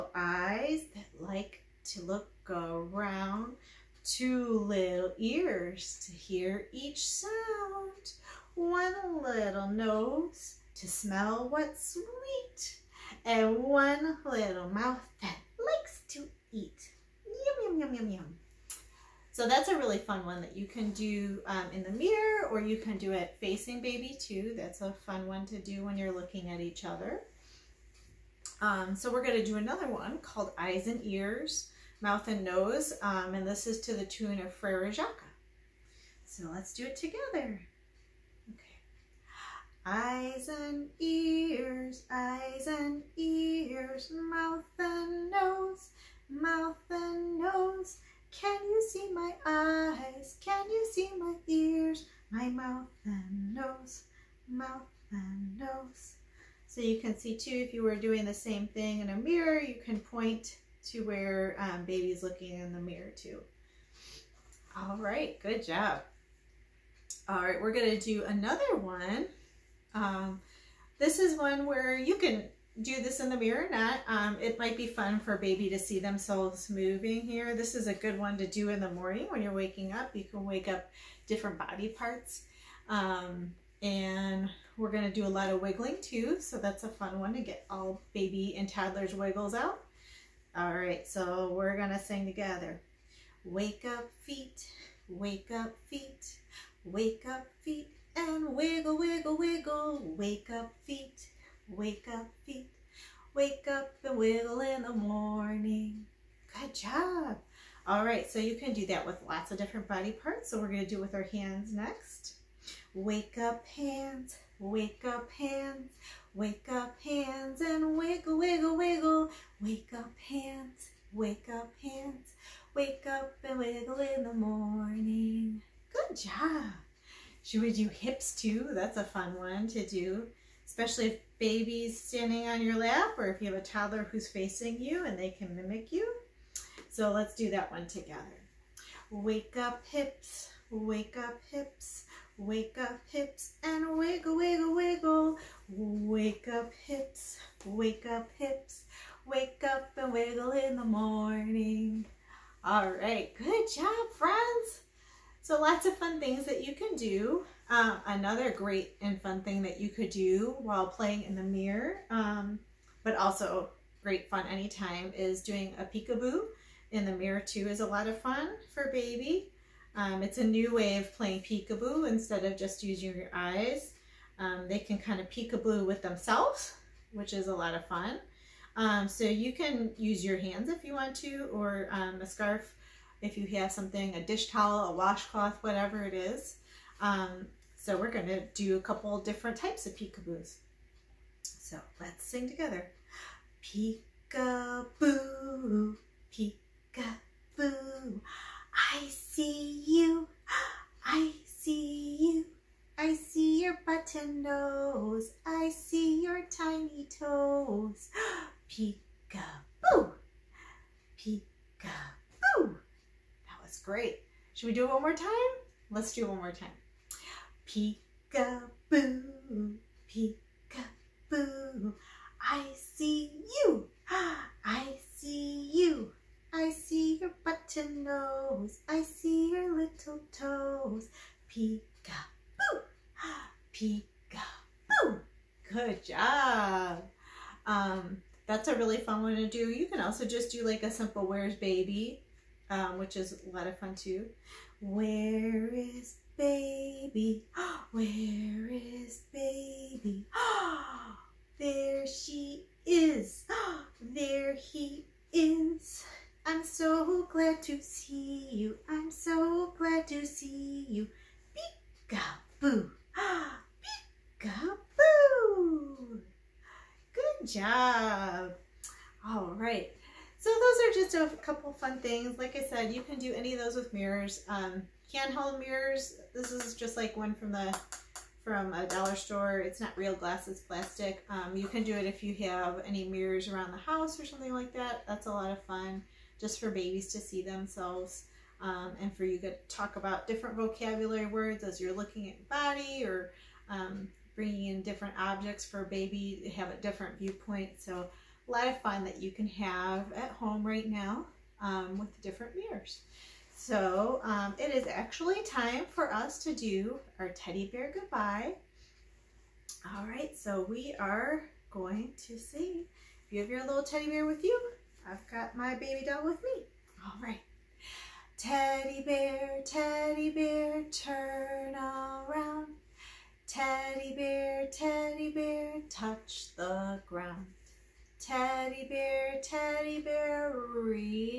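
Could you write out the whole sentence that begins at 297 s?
So a lot of fun that you can have at home right now um, with different mirrors.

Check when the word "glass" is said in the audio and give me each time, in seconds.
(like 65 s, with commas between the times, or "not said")
280 s.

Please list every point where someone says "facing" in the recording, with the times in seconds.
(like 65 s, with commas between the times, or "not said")
23 s, 134 s.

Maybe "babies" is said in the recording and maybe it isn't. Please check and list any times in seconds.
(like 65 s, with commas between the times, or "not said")
286 s.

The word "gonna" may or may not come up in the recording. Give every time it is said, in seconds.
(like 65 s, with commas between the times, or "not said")
67 s, 84 s, 91 s.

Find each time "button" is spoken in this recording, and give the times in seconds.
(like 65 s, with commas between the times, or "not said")
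203 s, 227 s.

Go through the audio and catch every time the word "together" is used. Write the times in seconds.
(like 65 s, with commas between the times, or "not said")
36 s, 92 s, 137 s, 192 s.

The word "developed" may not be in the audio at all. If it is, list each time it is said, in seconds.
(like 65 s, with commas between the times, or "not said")
not said.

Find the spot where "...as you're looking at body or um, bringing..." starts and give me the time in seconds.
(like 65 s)
291 s.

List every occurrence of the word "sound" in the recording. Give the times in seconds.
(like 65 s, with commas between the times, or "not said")
7 s.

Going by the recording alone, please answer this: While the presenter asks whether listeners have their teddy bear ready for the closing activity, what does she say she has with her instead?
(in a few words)
baby doll.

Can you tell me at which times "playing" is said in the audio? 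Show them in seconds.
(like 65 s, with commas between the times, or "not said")
160 s, 171 s.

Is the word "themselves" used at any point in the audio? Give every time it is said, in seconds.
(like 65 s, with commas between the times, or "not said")
75 s, 175 s, 287 s.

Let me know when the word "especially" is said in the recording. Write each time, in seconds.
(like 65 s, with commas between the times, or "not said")
130 s.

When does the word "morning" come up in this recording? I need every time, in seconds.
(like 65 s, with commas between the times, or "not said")
78 s, 104 s, 124 s, 150 s.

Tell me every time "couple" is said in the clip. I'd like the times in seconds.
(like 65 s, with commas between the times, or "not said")
188 s, 271 s.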